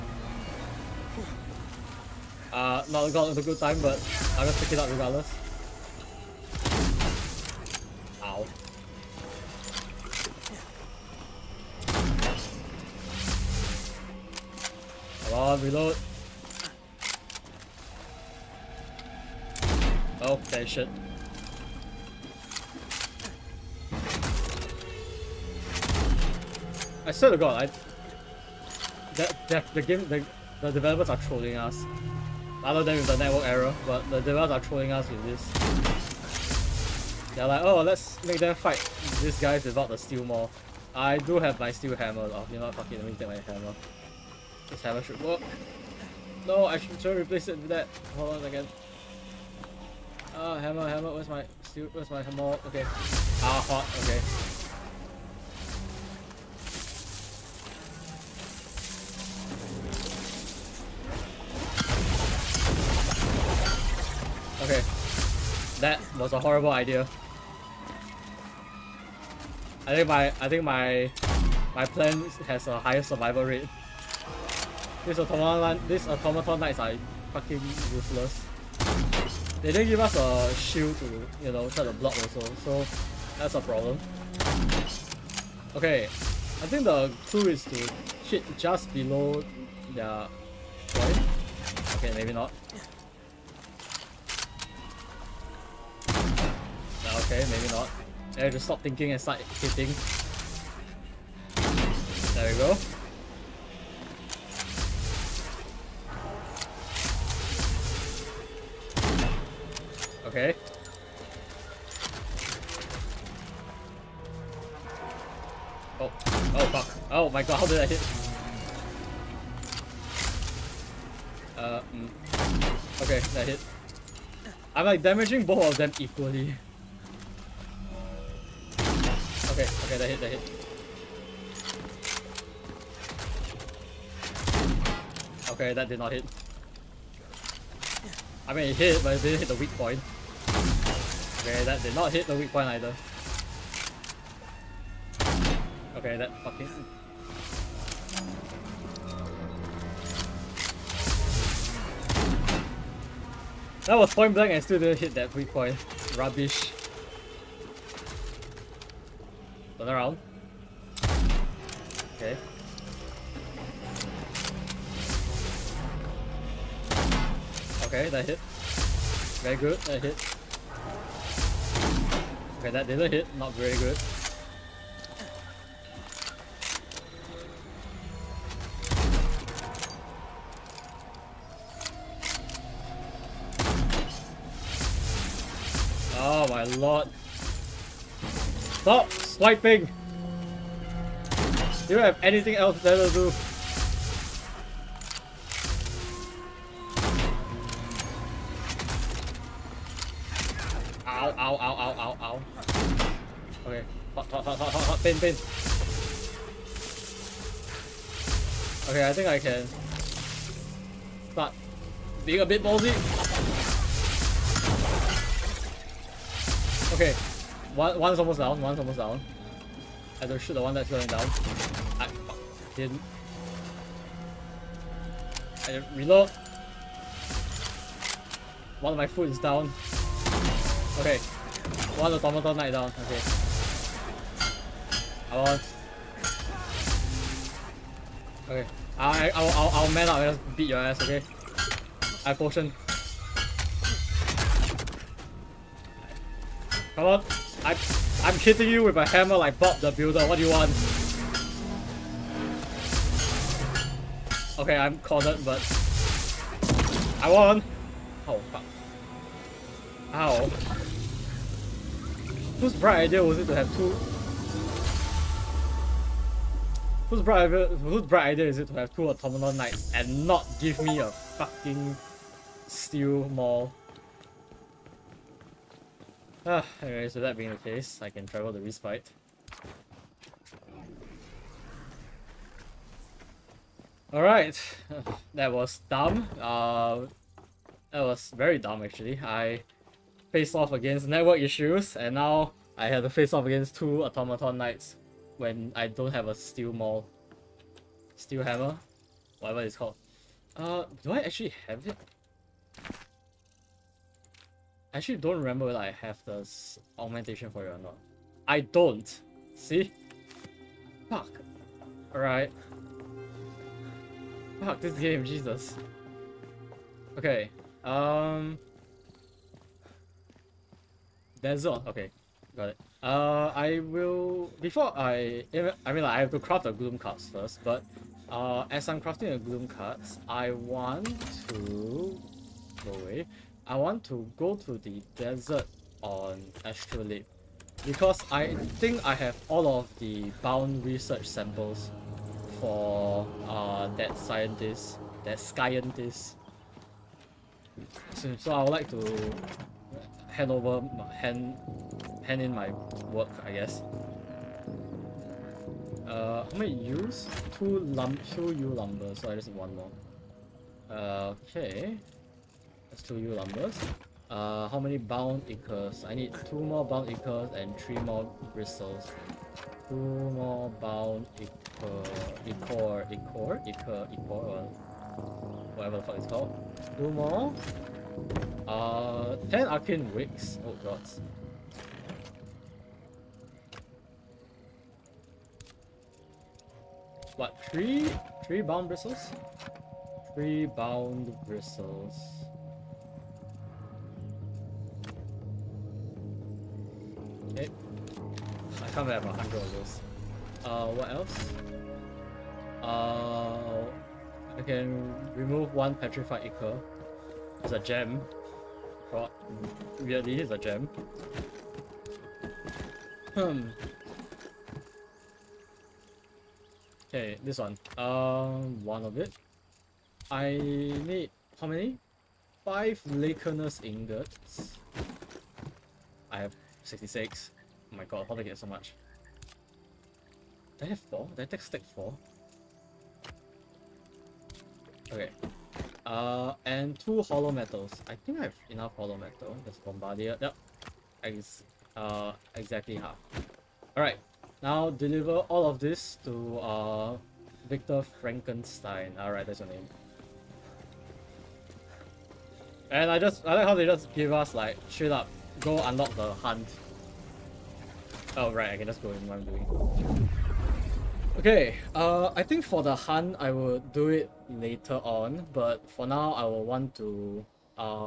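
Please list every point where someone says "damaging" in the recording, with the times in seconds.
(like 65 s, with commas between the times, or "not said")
125 s.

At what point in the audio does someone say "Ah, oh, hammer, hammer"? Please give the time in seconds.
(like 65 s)
50 s.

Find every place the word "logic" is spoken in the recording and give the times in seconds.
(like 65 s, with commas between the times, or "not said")
not said.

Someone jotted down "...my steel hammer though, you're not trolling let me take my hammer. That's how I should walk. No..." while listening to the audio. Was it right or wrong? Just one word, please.
wrong.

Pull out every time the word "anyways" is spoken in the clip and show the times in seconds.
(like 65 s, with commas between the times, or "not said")
276 s.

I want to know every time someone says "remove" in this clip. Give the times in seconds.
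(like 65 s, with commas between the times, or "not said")
405 s.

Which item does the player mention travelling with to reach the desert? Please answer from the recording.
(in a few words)
Astrolabe.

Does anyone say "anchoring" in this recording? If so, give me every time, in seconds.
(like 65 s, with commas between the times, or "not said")
not said.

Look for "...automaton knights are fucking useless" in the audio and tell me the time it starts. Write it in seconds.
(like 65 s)
76 s.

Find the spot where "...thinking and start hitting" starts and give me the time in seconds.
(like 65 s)
98 s.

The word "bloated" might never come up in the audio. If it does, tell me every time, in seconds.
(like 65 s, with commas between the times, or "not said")
not said.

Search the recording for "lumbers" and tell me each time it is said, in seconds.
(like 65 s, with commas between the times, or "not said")
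358 s, 363 s.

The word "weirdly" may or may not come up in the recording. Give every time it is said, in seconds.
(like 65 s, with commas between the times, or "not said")
410 s.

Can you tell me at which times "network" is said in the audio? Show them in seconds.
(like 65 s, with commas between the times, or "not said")
33 s, 291 s.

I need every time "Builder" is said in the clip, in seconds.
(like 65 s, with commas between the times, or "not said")
249 s.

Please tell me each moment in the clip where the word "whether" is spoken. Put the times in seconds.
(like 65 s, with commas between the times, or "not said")
305 s.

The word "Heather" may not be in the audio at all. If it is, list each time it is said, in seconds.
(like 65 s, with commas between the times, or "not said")
not said.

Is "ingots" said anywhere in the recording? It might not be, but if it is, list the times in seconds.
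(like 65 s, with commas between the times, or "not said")
423 s.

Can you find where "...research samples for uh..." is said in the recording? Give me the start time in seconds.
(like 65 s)
340 s.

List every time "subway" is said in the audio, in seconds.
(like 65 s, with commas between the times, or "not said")
not said.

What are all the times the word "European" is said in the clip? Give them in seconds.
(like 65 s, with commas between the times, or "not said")
not said.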